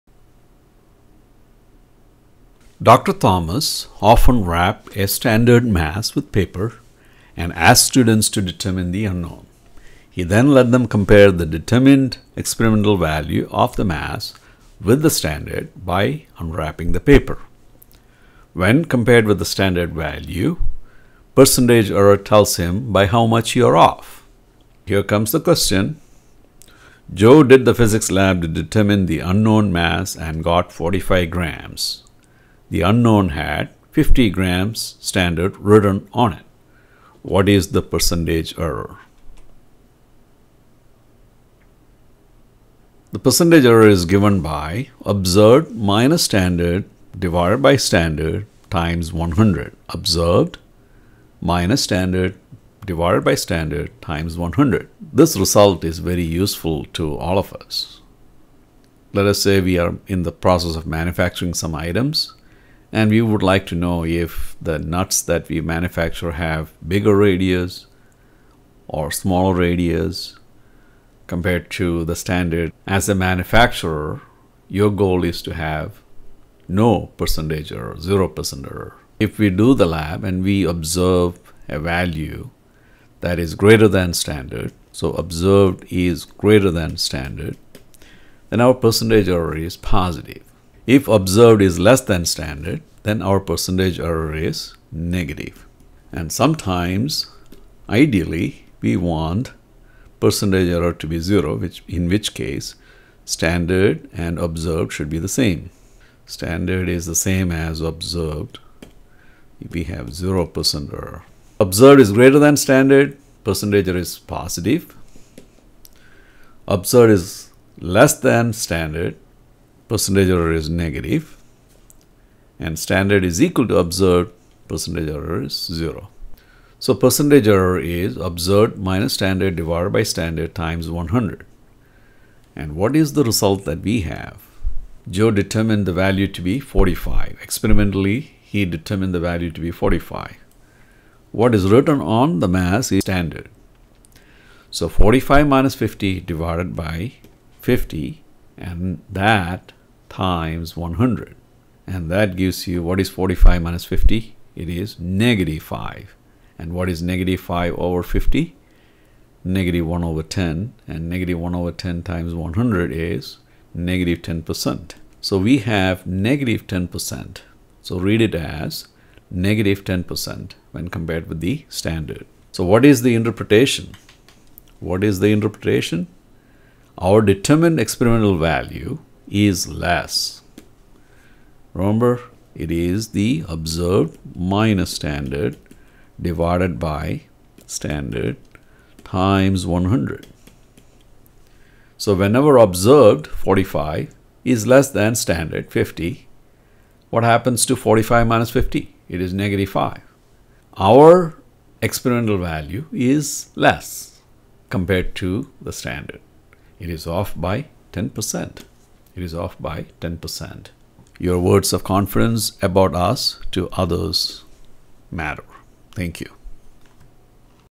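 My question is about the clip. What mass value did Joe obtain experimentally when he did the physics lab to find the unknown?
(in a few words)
45 grams.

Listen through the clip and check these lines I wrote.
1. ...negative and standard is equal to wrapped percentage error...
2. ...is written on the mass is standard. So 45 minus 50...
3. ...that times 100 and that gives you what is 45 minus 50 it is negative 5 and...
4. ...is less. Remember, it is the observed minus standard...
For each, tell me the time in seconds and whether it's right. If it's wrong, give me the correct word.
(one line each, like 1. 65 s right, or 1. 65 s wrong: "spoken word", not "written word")
1. 120 s wrong: "observed", not "wrapped"
2. 141 s right
3. 149 s right
4. 179 s right.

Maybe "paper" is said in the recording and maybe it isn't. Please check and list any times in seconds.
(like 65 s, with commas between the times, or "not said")
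6 s, 16 s.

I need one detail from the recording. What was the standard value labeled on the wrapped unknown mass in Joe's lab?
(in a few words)
50 grams.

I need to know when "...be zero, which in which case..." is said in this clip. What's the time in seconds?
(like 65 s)
101 s.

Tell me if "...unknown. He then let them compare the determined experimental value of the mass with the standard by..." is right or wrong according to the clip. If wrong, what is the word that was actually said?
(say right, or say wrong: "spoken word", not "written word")
right.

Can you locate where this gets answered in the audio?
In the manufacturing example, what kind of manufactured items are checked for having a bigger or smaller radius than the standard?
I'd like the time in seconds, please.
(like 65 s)
64 s.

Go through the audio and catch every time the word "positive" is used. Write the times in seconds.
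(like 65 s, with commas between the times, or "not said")
89 s, 114 s.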